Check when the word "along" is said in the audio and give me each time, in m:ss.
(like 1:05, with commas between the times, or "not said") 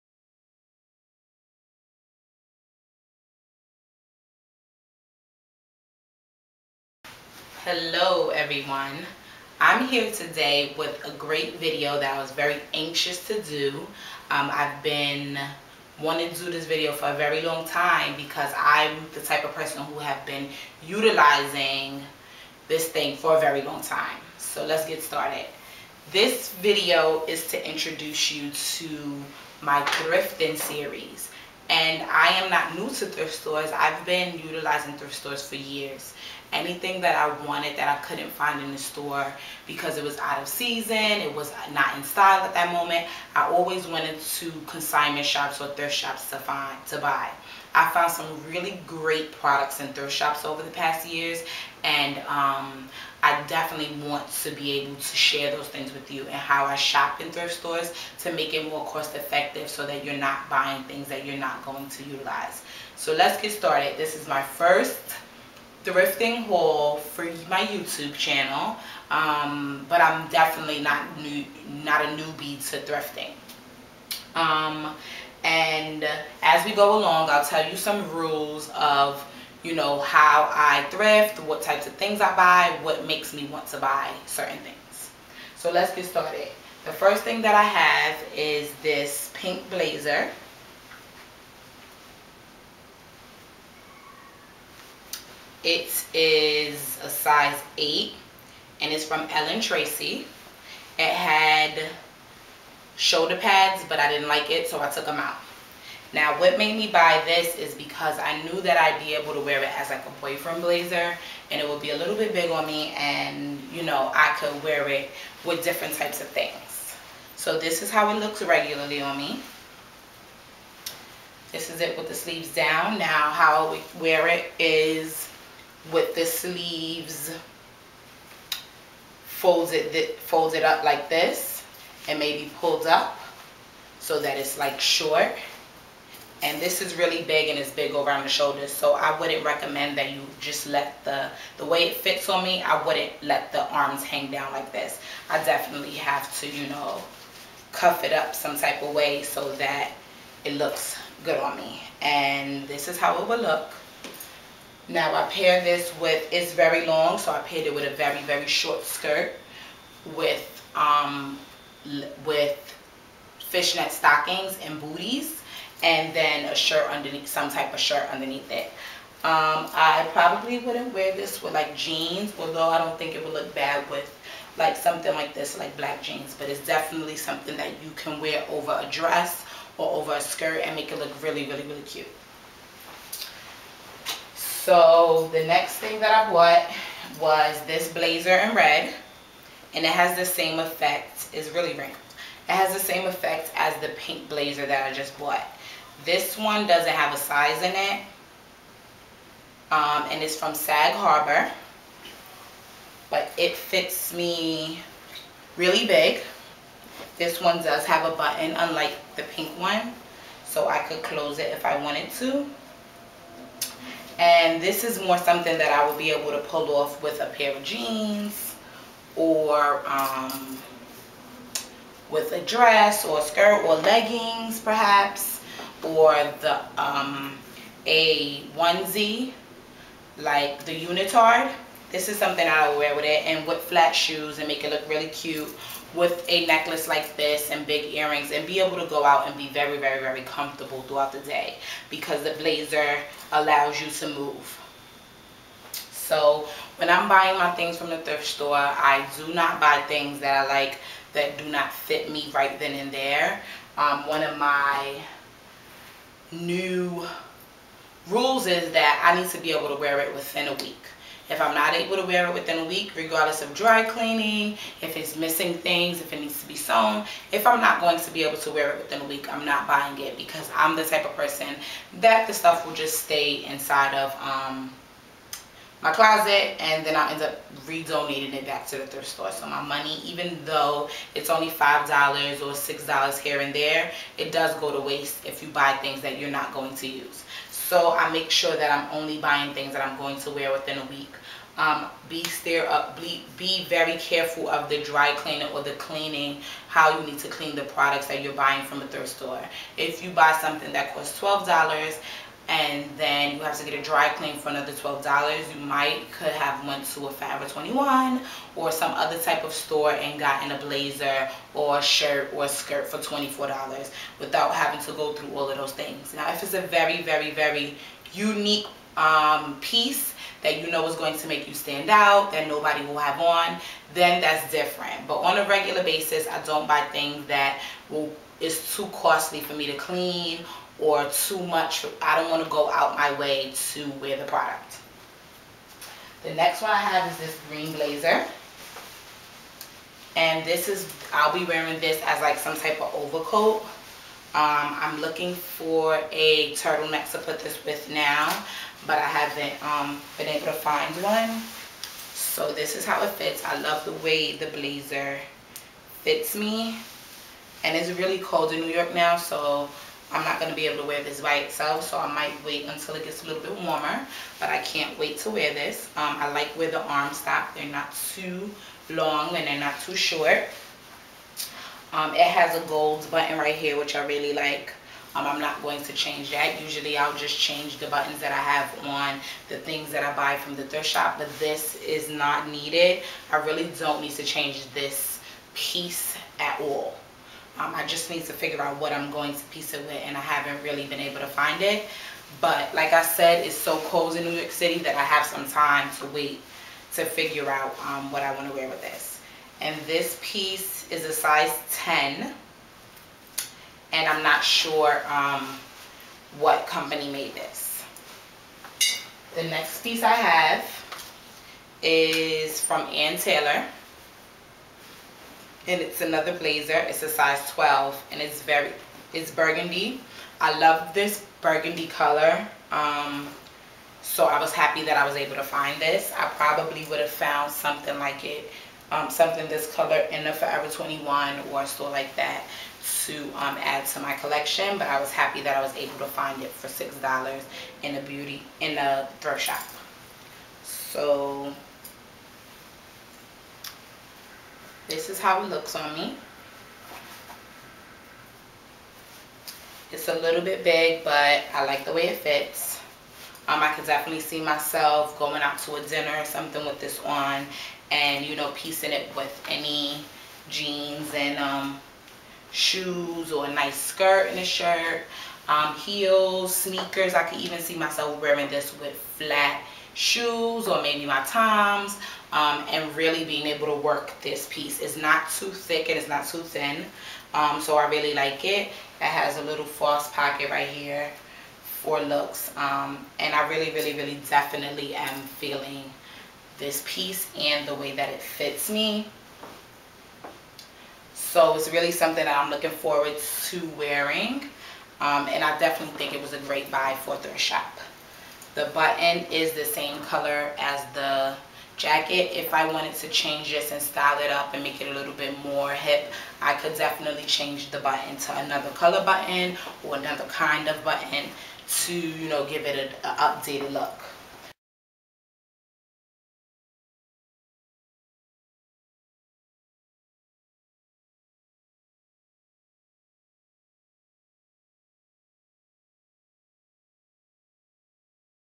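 1:16.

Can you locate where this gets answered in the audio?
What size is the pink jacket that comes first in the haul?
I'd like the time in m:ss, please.
1:37.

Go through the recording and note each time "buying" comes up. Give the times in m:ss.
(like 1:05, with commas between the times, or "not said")
1:00, 4:07, 4:29, 4:49, 4:58.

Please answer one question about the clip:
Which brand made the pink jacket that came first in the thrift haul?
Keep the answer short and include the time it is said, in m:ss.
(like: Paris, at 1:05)
Ellen Tracy, at 1:39.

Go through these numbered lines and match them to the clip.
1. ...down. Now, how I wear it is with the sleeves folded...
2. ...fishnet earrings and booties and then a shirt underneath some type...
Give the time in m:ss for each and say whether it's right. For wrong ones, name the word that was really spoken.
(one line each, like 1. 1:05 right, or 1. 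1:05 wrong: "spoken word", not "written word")
1. 2:02 right
2. 2:43 wrong: "stockings", not "earrings".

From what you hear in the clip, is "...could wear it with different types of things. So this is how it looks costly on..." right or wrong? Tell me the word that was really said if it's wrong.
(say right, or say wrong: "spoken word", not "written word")
wrong: "regularly", not "costly".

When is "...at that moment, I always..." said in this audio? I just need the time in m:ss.
0:42.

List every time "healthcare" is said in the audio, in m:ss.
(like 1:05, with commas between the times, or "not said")
not said.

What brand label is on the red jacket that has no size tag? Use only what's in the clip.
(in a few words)
Sag Harbor.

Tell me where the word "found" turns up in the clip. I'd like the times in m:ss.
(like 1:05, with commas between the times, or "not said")
0:47, 7:07.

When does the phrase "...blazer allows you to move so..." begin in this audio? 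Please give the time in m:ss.
4:02.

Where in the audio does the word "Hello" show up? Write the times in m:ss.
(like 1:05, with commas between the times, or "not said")
0:07.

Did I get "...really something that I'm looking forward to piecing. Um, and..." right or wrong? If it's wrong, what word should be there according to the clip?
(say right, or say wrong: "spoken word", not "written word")
wrong: "wearing", not "piecing".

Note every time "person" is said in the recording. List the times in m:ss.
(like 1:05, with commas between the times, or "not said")
0:19, 4:31.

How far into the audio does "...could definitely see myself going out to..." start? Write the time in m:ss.
7:33.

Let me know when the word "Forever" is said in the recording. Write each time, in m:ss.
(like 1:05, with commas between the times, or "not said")
5:07, 7:10.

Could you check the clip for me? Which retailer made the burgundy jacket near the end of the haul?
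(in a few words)
Ann Taylor.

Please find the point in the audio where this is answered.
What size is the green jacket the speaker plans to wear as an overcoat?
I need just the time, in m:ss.
6:41.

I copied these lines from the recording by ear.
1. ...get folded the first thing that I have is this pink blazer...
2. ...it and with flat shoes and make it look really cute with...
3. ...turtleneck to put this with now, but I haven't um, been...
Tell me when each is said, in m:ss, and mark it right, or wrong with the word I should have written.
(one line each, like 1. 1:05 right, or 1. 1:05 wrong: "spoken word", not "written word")
1. 1:25 wrong: "started", not "folded"
2. 3:53 right
3. 5:46 right.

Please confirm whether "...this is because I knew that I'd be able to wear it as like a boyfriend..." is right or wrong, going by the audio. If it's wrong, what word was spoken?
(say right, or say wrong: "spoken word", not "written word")
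right.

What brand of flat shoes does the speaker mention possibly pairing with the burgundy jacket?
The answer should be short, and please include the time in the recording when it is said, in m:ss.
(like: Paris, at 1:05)
Toms, at 7:51.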